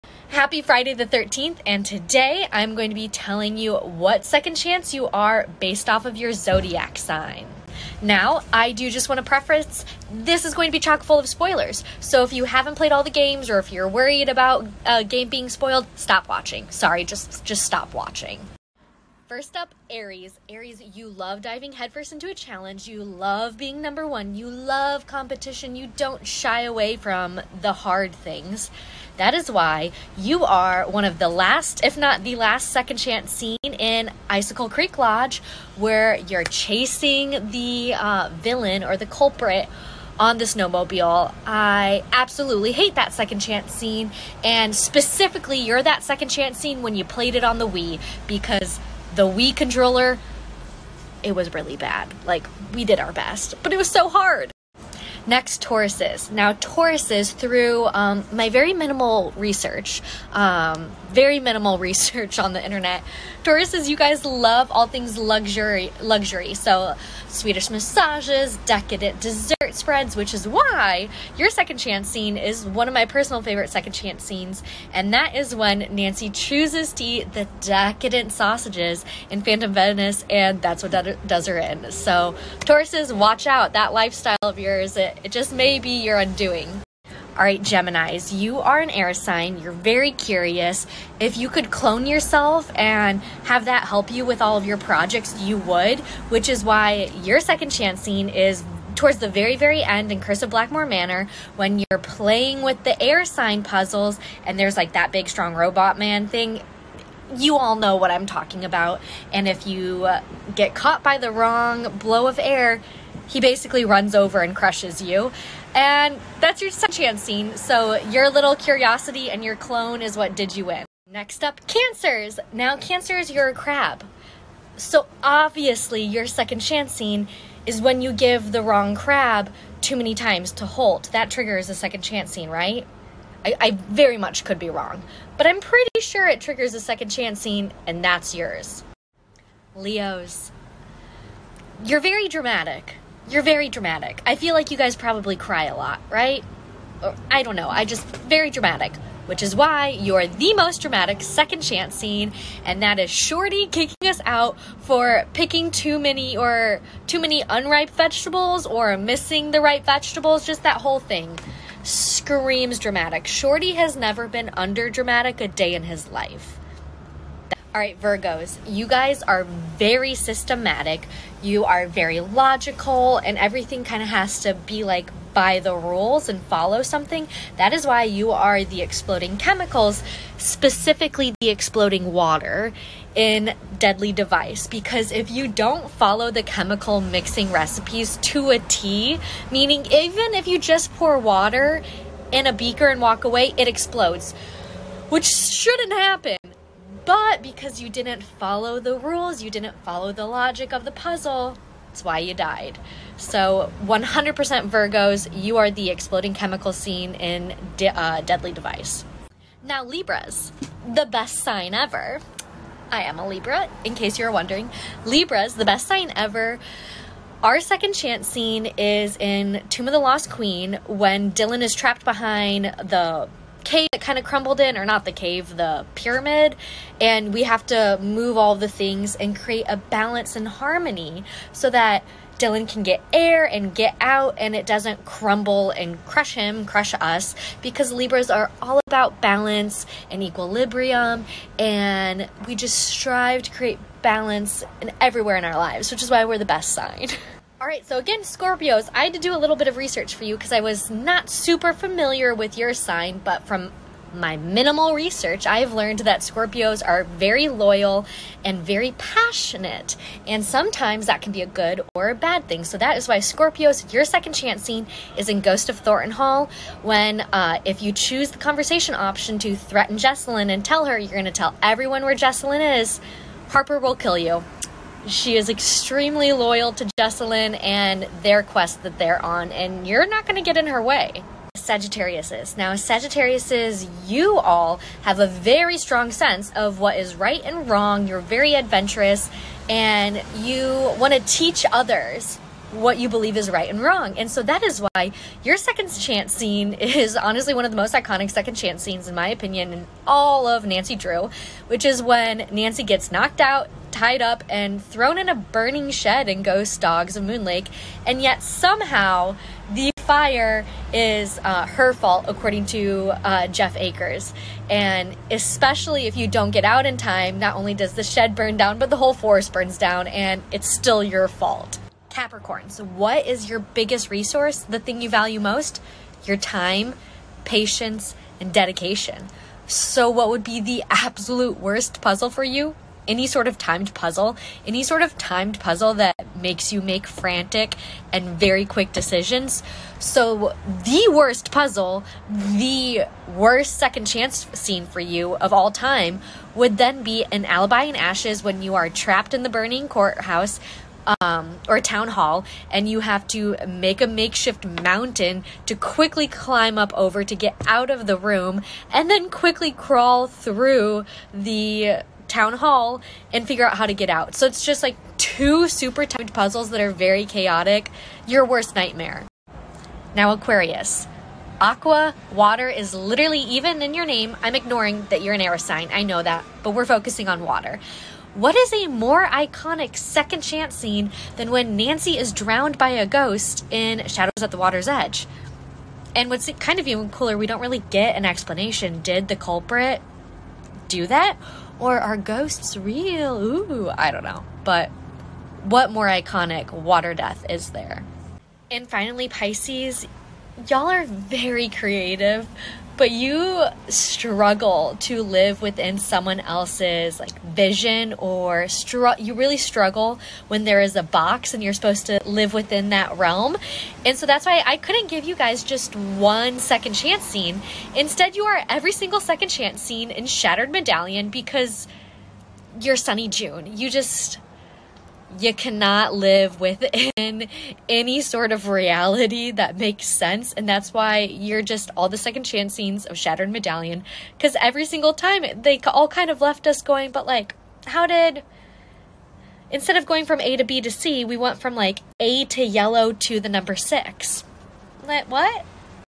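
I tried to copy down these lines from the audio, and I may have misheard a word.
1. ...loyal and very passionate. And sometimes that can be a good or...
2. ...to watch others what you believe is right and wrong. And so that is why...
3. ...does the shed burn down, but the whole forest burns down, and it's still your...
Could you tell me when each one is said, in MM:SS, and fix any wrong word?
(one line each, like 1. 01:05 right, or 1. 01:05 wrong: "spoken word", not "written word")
1. 04:17 right
2. 04:51 wrong: "teach", not "watch"
3. 05:17 right.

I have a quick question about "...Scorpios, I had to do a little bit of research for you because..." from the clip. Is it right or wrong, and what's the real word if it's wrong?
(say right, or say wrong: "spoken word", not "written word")
right.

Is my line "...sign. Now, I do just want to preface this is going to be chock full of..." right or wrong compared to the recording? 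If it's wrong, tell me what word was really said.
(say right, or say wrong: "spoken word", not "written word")
right.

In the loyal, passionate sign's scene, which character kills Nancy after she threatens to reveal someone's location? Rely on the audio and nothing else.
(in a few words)
Harper.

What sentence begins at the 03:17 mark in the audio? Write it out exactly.
But because you didn't follow the rules, you didn't follow the logic of the puzzle, it's why you died.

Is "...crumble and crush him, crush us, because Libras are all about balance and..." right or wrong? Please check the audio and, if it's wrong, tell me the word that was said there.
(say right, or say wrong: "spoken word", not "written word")
right.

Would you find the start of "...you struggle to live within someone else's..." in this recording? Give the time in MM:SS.
06:43.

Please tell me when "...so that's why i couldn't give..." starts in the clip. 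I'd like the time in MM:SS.
06:54.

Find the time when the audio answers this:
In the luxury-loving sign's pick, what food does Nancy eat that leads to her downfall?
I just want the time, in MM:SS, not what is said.
01:18.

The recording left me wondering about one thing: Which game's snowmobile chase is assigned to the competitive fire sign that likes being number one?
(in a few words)
Icicle Creek Lodge.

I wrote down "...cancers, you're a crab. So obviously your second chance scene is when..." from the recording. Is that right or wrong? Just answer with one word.
right.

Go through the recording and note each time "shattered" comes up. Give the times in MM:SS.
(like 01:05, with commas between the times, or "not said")
07:00, 07:13.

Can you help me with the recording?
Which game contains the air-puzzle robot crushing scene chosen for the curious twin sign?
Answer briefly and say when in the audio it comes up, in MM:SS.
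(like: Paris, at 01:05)
Curse of Blackmore Manor, at 01:40.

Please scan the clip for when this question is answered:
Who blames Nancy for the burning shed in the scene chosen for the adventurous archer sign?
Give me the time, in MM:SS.
05:13.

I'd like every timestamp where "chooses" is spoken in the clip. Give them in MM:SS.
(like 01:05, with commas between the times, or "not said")
01:16, 04:27.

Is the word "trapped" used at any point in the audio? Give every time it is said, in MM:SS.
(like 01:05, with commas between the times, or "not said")
03:41, 05:48.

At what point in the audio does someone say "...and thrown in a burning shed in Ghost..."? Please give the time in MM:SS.
05:04.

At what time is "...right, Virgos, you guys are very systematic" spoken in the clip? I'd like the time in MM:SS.
02:47.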